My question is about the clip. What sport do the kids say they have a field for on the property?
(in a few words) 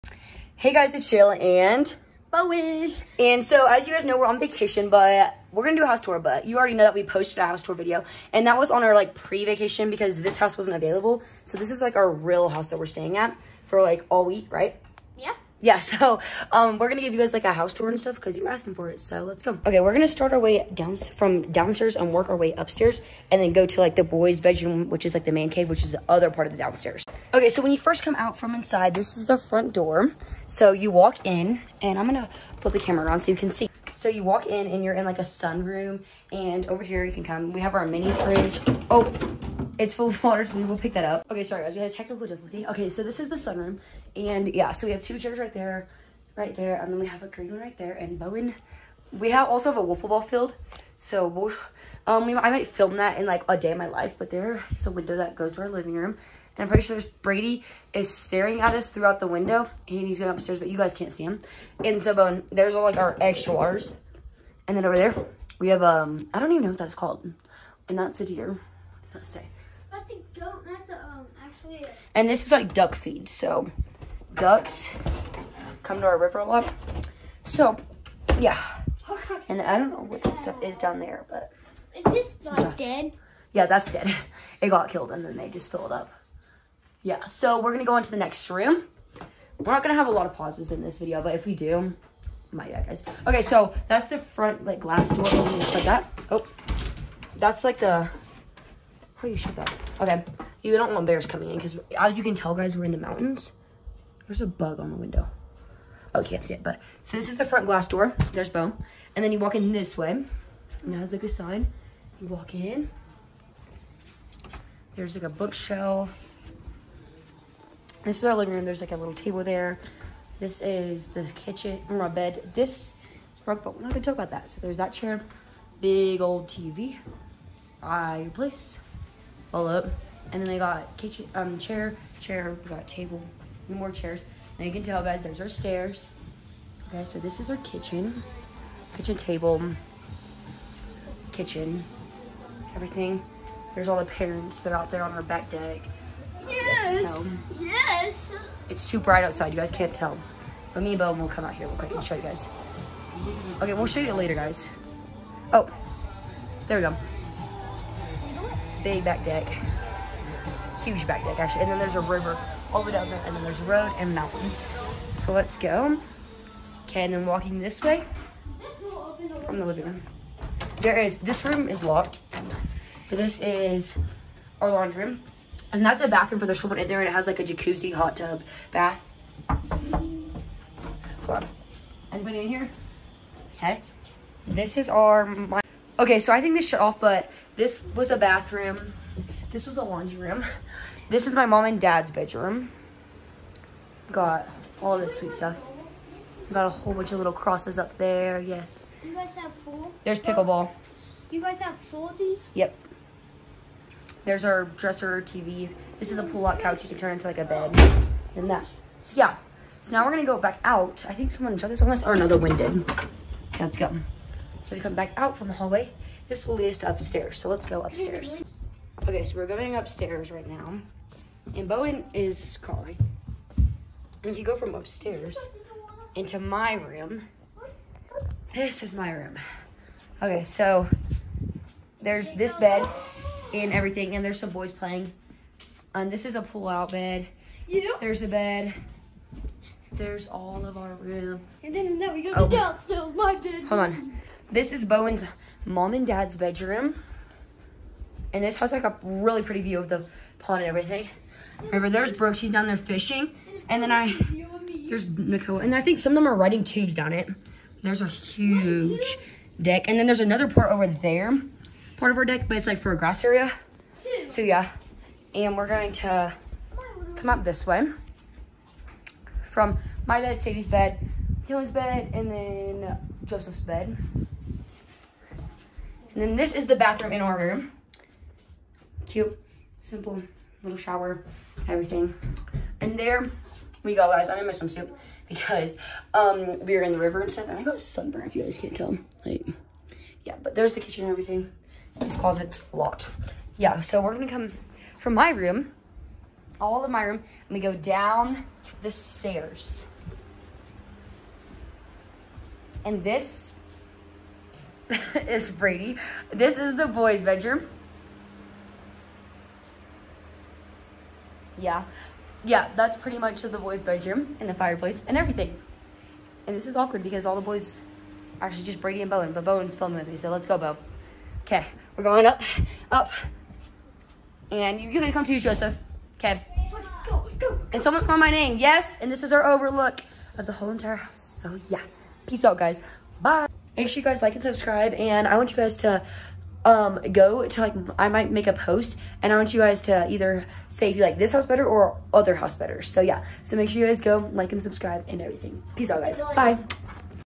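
Wiffle ball.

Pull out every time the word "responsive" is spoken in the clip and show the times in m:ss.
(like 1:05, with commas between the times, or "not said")
not said.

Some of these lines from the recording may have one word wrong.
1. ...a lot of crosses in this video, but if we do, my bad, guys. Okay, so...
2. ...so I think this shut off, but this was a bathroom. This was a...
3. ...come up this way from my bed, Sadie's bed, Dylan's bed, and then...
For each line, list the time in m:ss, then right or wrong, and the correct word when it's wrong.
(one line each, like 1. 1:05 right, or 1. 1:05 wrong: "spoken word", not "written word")
1. 1:30 wrong: "pauses", not "crosses"
2. 3:06 right
3. 4:27 right.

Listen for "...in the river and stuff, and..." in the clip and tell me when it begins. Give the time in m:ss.
4:46.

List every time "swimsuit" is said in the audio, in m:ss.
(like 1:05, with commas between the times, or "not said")
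4:44.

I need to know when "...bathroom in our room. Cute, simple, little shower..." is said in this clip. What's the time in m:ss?
4:36.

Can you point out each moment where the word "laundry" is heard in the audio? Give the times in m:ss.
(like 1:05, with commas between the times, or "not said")
2:54, 3:09.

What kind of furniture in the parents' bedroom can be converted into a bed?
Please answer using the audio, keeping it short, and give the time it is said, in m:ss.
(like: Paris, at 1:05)
Pull-out couch, at 3:26.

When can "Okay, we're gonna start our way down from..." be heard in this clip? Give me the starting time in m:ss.
0:19.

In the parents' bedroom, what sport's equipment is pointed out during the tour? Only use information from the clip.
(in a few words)
Pickleball.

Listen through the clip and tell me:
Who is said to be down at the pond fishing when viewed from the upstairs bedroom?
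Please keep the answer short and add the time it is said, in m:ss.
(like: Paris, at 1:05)
Brooks, at 4:12.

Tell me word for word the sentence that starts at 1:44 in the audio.
There's a bug on the window.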